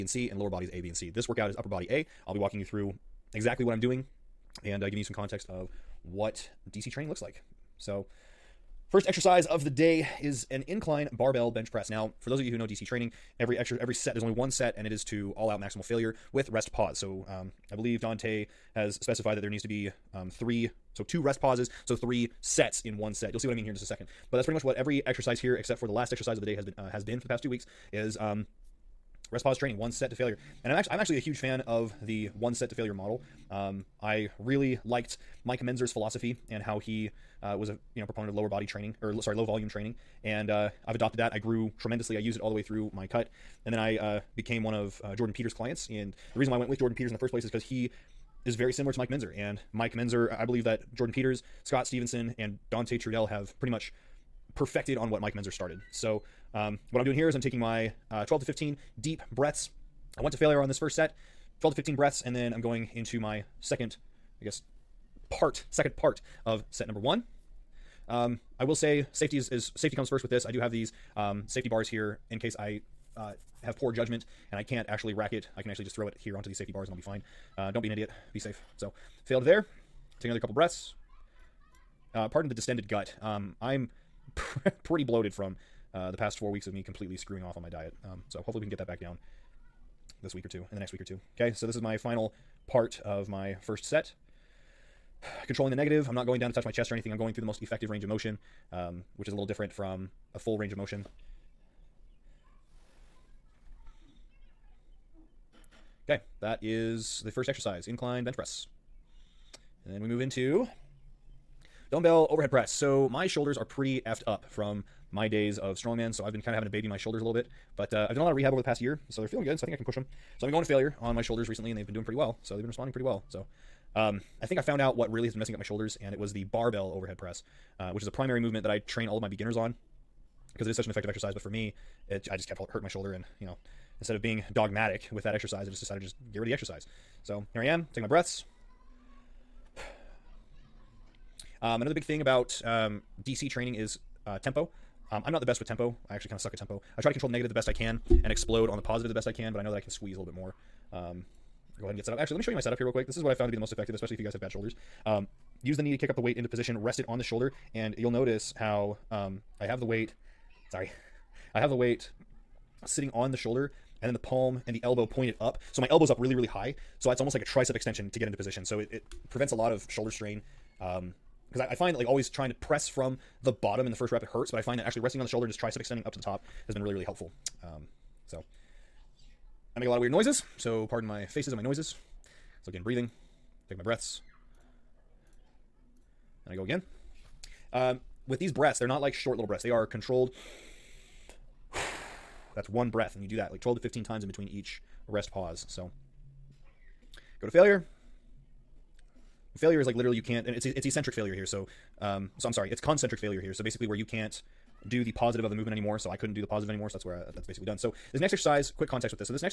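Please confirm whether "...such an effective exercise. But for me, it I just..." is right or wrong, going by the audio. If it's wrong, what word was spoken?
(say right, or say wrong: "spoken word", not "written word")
right.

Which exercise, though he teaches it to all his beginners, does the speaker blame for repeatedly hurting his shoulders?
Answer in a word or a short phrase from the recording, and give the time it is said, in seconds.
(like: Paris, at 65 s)
barbell overhead press, at 126 s.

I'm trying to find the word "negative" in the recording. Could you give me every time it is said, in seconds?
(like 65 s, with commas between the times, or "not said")
95 s, 147 s.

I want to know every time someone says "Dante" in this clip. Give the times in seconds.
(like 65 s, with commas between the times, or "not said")
18 s, 52 s.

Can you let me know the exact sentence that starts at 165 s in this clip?
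So my elbow's up really, really high.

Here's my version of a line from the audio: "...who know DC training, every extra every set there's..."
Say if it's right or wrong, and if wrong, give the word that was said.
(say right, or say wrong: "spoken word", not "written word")
right.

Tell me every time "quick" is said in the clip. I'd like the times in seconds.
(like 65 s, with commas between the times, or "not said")
152 s, 208 s.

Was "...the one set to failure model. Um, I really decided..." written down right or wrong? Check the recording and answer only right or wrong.
wrong.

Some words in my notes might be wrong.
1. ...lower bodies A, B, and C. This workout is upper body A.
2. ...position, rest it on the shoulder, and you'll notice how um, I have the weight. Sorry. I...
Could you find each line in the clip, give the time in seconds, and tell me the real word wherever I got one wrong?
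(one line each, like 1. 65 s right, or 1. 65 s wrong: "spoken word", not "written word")
1. 0 s right
2. 156 s right.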